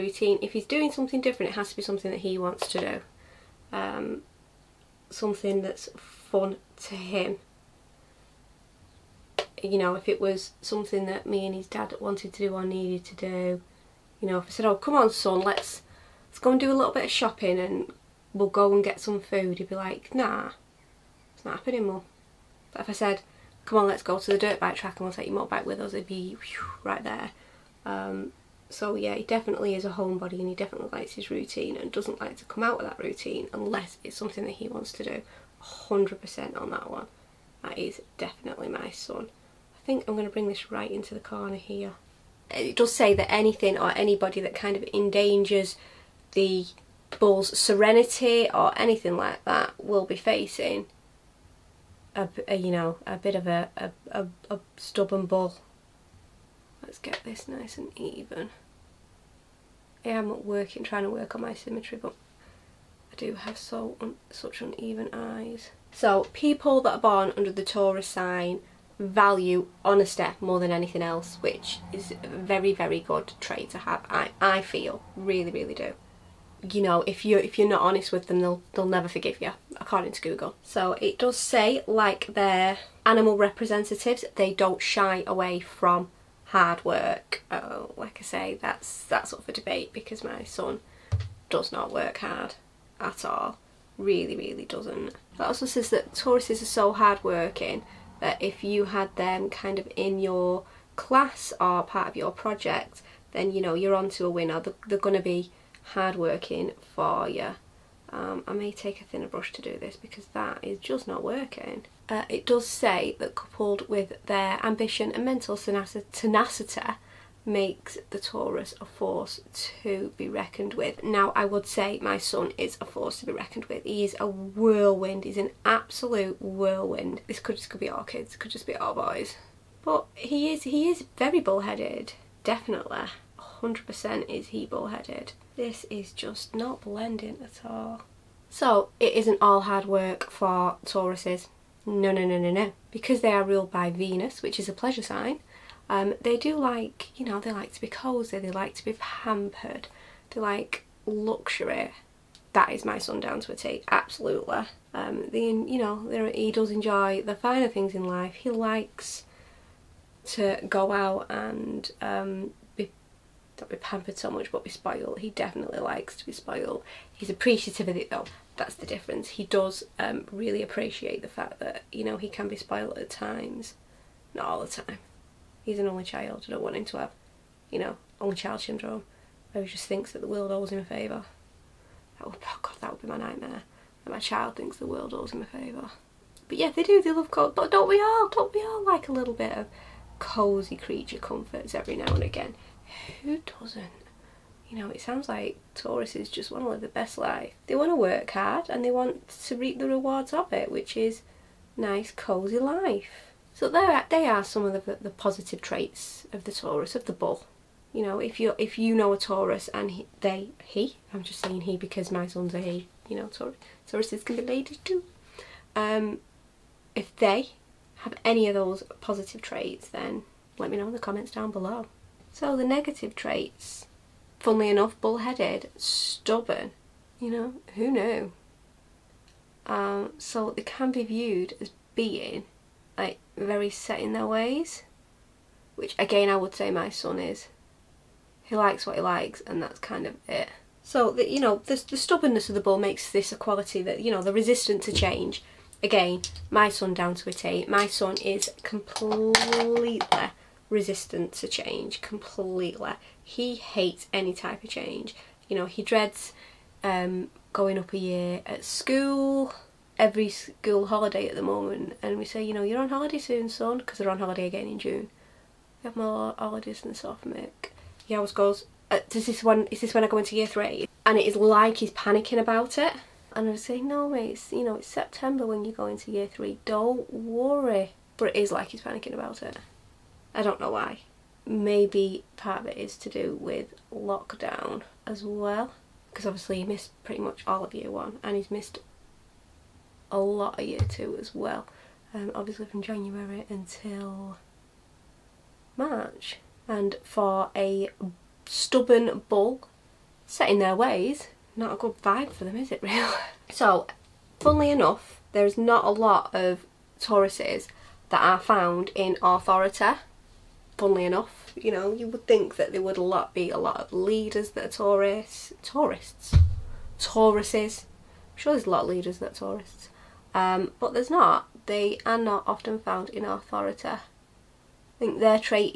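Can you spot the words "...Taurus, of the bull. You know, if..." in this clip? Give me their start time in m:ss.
3:26.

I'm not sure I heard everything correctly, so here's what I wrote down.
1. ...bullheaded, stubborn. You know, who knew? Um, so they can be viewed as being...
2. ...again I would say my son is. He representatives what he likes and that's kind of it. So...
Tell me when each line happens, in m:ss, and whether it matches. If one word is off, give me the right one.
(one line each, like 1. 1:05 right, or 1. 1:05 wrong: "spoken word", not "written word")
1. 3:45 right
2. 3:55 wrong: "likes", not "representatives".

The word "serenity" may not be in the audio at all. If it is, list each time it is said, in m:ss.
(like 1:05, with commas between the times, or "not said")
0:47.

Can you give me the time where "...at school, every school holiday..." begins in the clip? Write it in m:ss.
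4:18.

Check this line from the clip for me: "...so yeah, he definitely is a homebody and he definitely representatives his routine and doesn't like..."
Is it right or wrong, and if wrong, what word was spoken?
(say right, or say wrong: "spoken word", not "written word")
wrong: "likes", not "representatives".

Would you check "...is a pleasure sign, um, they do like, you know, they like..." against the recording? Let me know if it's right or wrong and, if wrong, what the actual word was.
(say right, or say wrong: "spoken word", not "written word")
right.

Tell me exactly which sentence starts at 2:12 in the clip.
Definitely, hundred percent is he bullheaded.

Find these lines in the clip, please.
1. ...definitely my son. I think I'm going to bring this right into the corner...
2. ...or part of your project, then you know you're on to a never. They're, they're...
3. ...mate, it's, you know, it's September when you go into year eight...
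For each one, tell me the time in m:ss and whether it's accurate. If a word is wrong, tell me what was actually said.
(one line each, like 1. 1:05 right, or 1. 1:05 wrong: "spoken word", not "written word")
1. 0:38 right
2. 1:41 wrong: "winner", not "never"
3. 4:34 wrong: "three", not "eight".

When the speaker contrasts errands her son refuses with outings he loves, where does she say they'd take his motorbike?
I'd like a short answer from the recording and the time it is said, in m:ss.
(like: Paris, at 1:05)
the dirt bike track, at 0:24.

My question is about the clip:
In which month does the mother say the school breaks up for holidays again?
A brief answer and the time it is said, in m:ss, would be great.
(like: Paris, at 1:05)
June, at 4:24.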